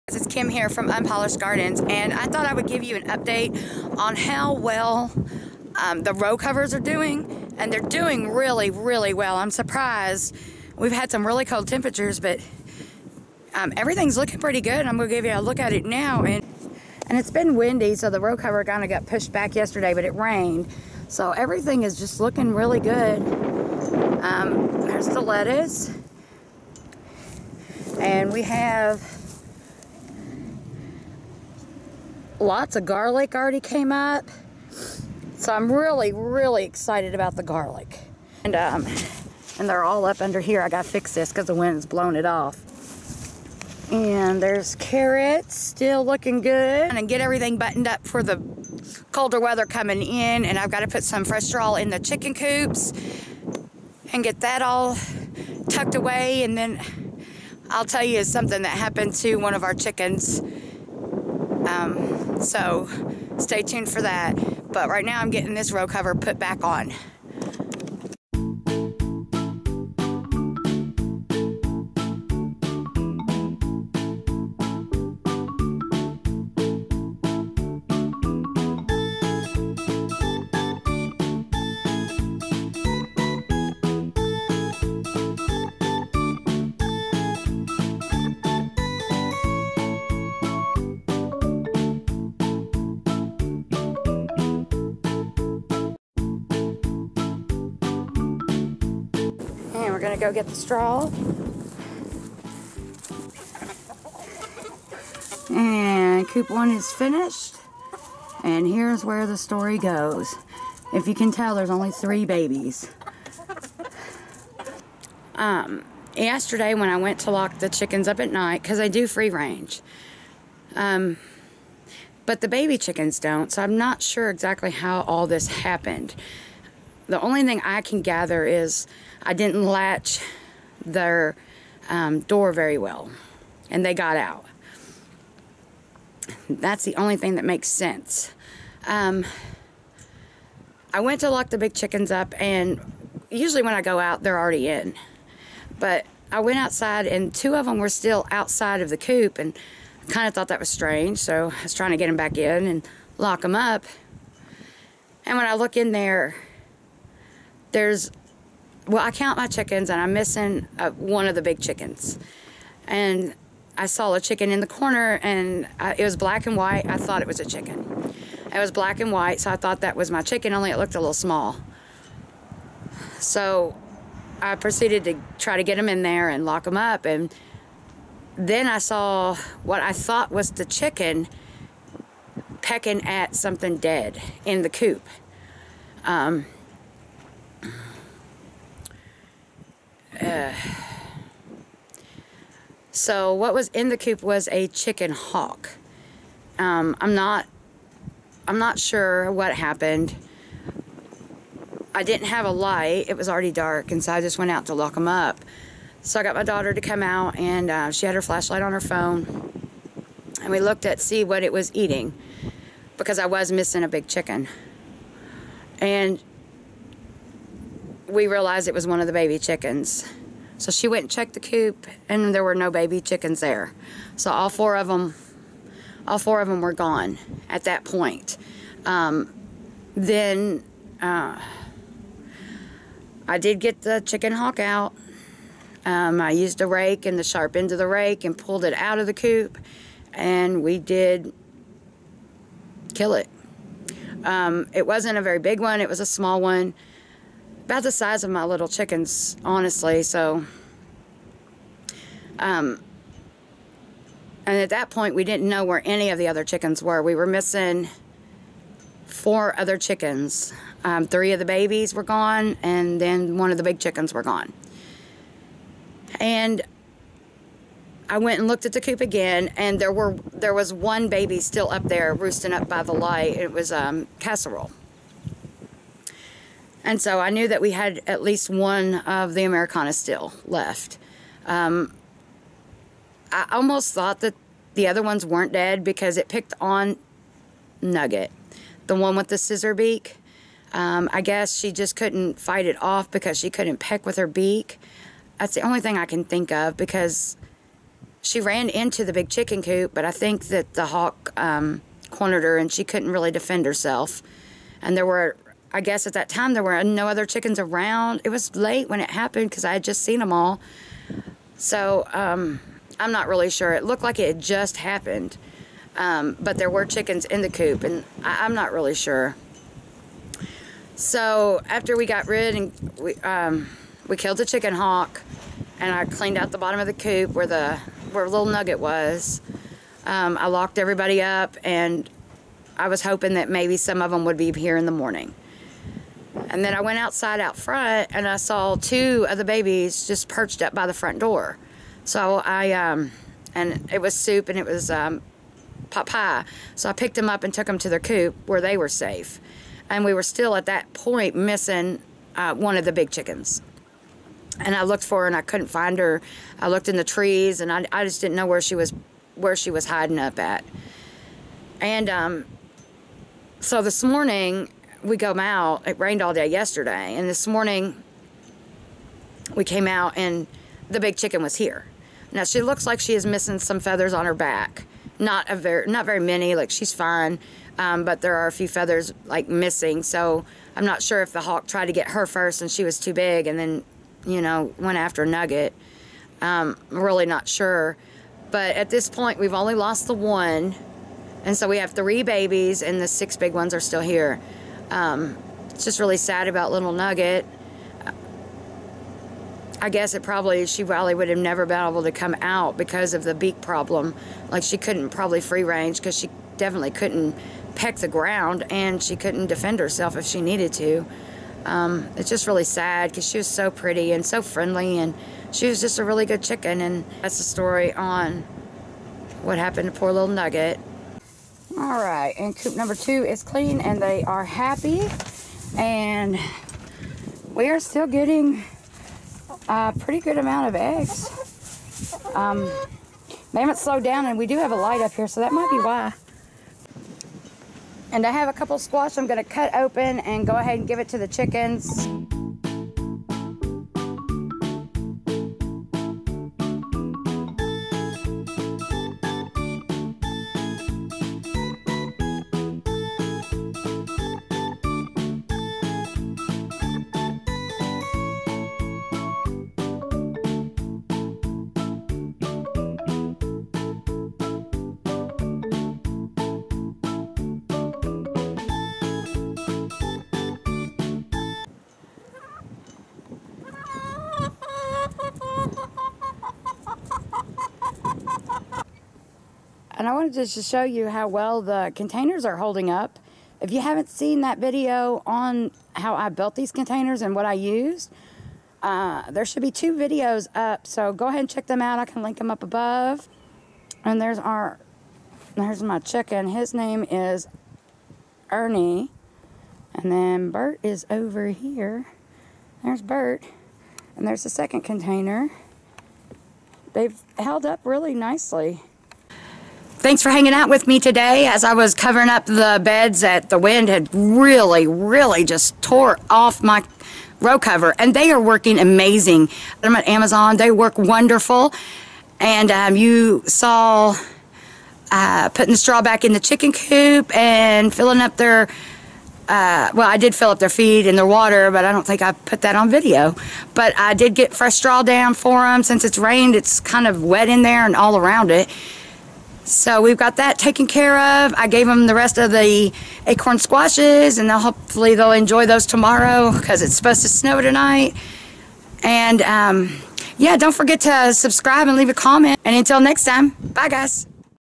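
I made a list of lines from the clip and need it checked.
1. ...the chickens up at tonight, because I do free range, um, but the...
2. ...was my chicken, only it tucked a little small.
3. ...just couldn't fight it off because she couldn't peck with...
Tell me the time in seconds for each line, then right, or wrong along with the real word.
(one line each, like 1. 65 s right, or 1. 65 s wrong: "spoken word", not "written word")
1. 117 s wrong: "night", not "tonight"
2. 169 s wrong: "looked", not "tucked"
3. 291 s right.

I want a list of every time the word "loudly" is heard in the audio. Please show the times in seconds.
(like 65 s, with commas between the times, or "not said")
not said.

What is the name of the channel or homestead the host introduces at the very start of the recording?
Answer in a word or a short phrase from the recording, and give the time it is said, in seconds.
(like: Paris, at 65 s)
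Unpolished Gardens, at 0 s.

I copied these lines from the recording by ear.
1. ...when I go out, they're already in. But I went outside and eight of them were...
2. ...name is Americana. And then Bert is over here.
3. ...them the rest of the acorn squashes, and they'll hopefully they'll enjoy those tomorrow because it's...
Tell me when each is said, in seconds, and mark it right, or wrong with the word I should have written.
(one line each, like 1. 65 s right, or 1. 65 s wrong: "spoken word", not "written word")
1. 143 s wrong: "two", not "eight"
2. 496 s wrong: "Ernie", not "Americana"
3. 541 s right.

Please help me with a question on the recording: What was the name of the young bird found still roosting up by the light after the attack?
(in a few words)
Casserole.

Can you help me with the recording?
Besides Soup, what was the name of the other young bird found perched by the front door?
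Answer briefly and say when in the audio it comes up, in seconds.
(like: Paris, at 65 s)
Pot Pie, at 345 s.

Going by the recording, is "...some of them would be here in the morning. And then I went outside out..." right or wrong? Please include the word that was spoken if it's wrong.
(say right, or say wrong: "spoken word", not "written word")
right.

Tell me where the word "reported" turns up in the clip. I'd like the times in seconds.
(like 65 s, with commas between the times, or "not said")
not said.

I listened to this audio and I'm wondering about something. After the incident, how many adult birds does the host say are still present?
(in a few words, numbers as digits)
6.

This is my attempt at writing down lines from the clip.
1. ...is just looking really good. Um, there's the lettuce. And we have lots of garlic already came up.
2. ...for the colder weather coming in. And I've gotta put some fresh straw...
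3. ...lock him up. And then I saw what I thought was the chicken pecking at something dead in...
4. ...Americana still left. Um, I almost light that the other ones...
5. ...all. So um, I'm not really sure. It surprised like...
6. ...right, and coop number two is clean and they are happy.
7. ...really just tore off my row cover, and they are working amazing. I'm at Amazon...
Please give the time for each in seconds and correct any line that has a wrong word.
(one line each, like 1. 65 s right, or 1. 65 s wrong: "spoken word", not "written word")
1. 21 s right
2. 48 s right
3. 176 s right
4. 279 s wrong: "thought", not "light"
5. 310 s wrong: "looked", not "surprised"
6. 422 s right
7. 514 s right.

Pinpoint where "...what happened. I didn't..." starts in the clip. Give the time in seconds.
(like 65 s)
199 s.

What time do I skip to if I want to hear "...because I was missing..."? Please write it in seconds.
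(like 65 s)
212 s.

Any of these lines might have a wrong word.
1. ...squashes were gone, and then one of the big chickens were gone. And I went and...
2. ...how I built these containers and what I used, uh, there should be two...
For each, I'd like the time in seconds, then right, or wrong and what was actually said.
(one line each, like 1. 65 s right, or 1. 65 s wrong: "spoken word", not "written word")
1. 261 s wrong: "babies", not "squashes"
2. 485 s right.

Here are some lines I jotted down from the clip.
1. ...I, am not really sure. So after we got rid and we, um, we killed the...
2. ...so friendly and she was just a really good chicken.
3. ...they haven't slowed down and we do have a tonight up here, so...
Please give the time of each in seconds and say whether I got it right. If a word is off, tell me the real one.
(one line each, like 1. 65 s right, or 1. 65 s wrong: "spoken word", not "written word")
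1. 318 s right
2. 414 s right
3. 433 s wrong: "light", not "tonight".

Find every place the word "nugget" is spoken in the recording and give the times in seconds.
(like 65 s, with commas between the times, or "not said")
287 s, 328 s, 385 s, 396 s, 420 s.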